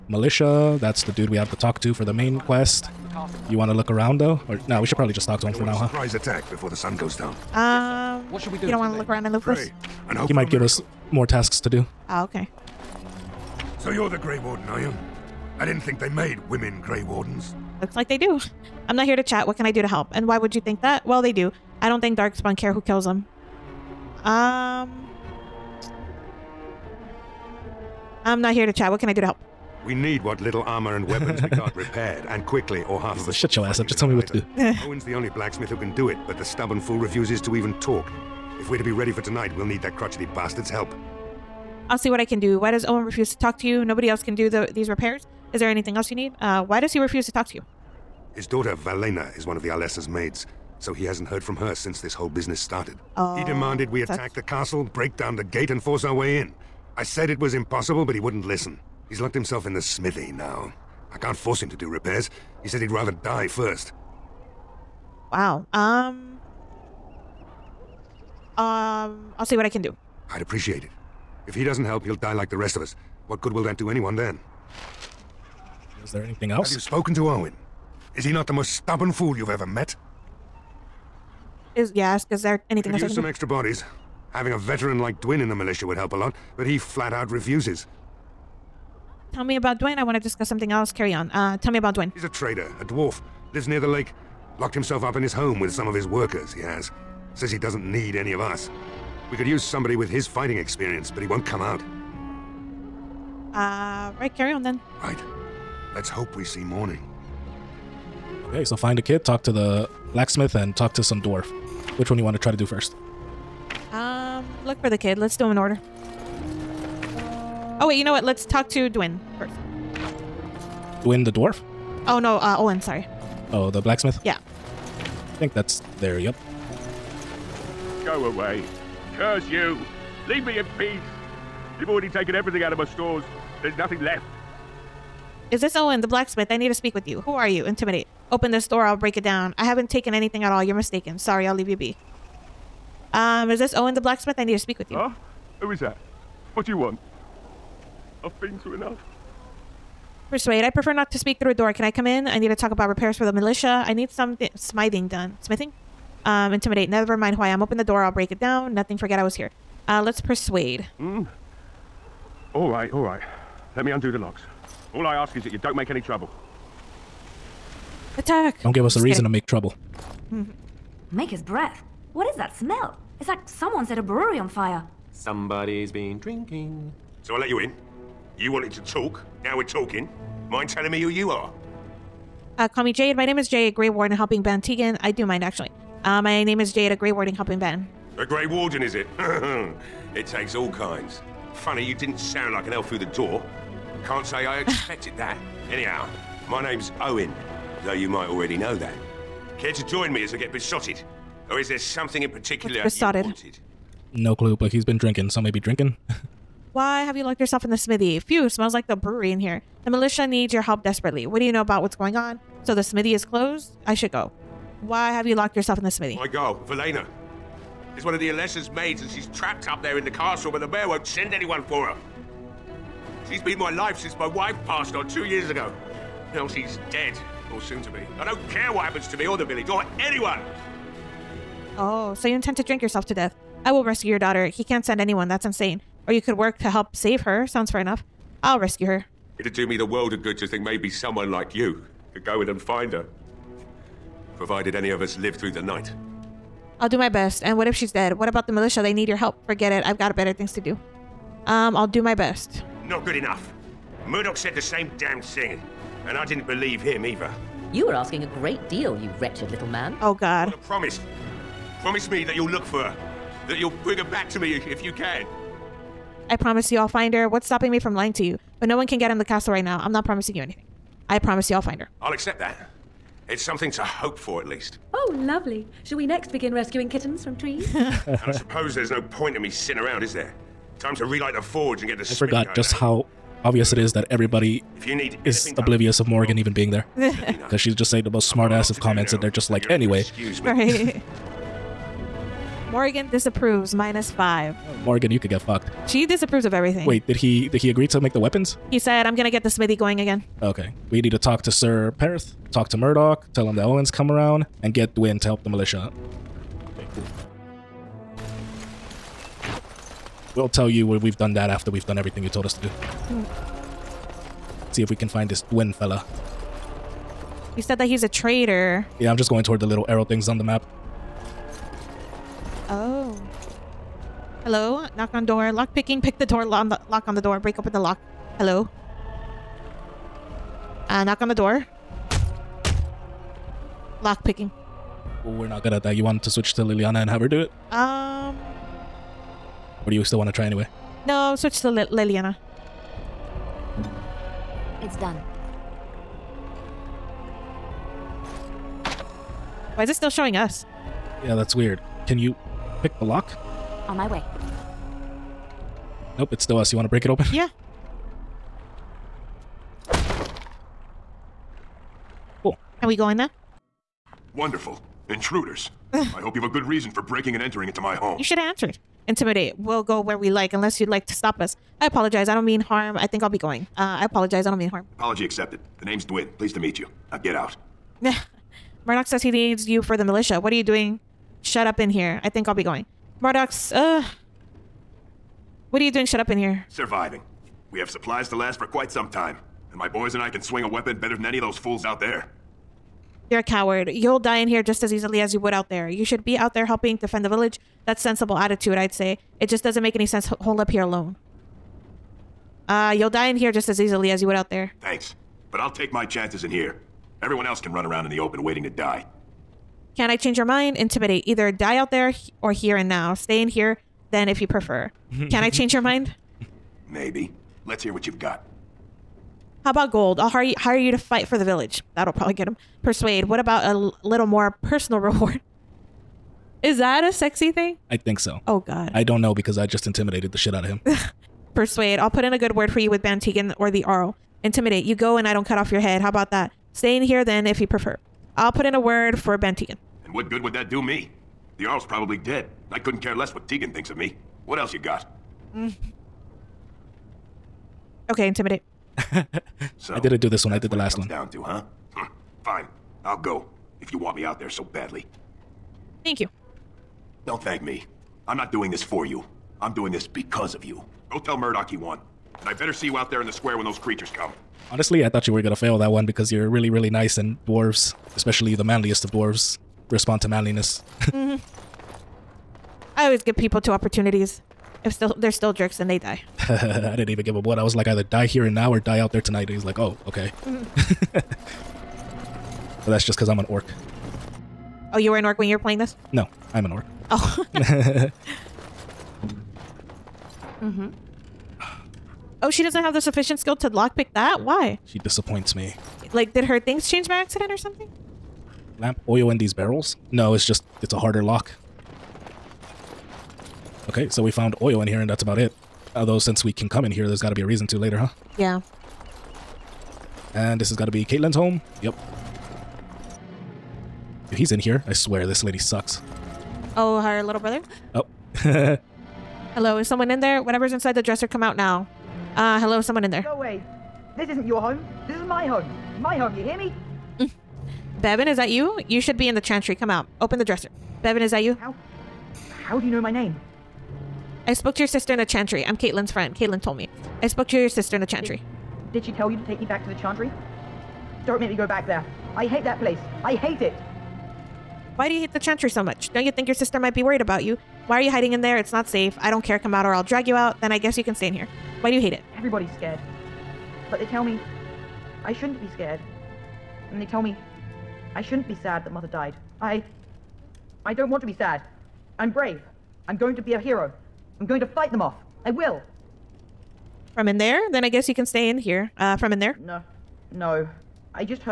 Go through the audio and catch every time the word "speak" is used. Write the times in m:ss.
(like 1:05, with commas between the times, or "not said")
2:16, 2:24, 2:31.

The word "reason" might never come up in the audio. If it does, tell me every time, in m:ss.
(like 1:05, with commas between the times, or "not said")
2:49, 6:06, 8:27.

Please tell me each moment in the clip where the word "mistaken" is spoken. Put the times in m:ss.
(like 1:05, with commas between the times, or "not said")
2:20.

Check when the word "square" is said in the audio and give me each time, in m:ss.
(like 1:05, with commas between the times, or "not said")
7:43.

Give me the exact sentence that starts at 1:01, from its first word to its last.
I can't force him to do repairs.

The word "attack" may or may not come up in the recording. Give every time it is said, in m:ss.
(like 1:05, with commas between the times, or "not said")
0:06, 0:54, 2:48.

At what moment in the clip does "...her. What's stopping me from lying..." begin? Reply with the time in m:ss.
4:27.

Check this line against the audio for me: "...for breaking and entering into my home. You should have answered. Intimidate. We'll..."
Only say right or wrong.
right.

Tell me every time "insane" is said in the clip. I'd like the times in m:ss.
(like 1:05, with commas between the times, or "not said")
3:55.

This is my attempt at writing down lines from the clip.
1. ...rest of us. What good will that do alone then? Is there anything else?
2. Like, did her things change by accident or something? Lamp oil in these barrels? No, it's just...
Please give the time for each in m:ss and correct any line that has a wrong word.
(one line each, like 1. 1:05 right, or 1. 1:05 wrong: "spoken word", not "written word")
1. 1:12 wrong: "anyone", not "alone"
2. 8:16 right.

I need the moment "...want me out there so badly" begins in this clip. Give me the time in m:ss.
7:33.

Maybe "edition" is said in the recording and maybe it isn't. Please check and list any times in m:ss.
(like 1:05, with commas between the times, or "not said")
not said.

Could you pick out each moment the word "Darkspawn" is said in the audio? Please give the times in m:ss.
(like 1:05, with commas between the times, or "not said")
0:22.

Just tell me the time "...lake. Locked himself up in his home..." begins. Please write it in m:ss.
1:33.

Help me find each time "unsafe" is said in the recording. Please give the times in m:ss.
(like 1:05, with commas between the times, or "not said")
not said.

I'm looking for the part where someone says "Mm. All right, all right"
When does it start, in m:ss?
2:40.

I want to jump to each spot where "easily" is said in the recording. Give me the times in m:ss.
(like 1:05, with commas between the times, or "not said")
6:34, 6:43.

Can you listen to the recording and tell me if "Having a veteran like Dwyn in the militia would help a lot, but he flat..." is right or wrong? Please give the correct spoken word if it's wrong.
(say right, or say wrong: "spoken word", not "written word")
right.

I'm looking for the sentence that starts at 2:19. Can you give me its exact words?
I haven't taken anything at all.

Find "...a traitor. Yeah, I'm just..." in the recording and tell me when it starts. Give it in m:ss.
5:18.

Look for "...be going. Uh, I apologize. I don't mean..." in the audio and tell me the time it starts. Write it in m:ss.
6:13.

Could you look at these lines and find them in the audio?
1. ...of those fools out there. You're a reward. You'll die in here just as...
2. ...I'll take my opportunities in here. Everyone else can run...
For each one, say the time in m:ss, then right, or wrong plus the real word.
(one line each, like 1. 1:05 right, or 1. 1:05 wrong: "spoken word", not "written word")
1. 6:31 wrong: "coward", not "reward"
2. 6:45 wrong: "chances", not "opportunities".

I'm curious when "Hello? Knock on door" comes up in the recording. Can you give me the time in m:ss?
5:24.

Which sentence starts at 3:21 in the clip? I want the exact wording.
Or is there something in particular What's besotted?